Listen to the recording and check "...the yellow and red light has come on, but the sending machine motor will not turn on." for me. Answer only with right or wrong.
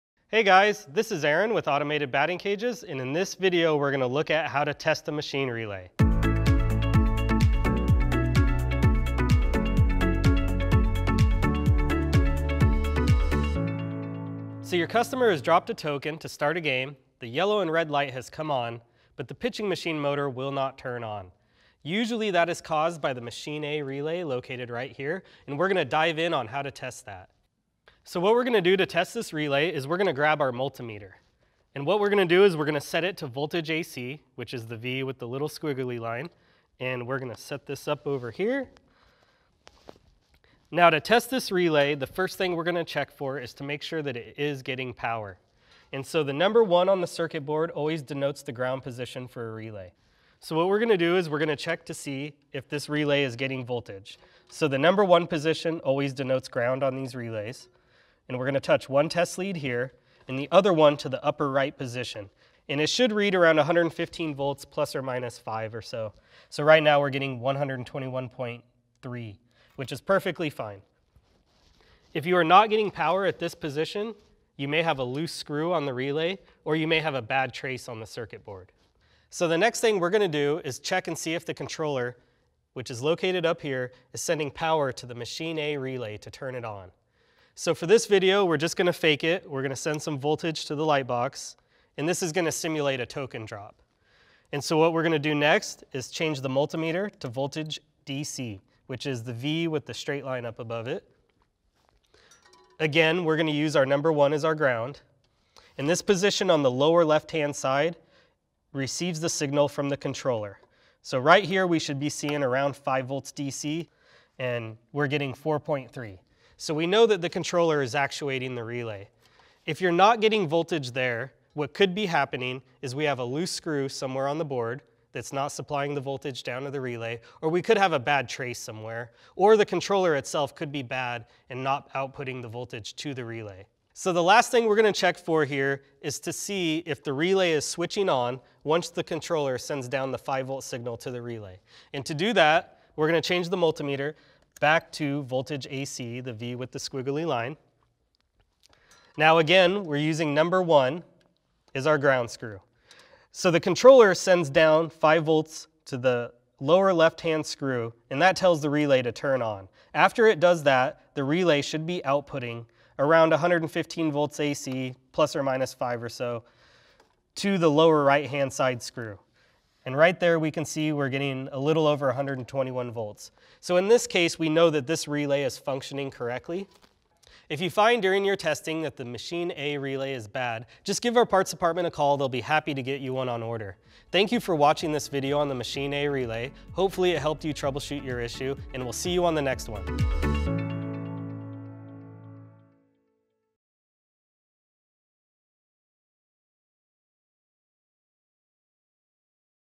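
wrong.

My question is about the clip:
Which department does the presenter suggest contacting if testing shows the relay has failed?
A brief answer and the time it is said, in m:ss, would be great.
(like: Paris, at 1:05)
parts department, at 3:01.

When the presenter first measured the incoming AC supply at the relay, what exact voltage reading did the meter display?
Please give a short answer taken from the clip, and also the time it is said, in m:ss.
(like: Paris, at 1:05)
121.3, at 1:07.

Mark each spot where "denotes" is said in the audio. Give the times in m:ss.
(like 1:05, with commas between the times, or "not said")
0:48, 0:56.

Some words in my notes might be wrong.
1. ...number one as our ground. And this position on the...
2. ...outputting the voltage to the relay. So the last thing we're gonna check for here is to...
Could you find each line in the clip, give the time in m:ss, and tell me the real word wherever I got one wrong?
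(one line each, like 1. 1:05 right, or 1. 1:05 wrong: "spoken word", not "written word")
1. 1:43 right
2. 2:11 right.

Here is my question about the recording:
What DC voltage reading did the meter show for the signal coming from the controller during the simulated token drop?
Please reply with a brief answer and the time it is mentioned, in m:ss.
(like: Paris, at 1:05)
4.3, at 1:55.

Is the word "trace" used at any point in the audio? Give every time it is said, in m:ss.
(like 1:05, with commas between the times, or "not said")
1:17, 2:08.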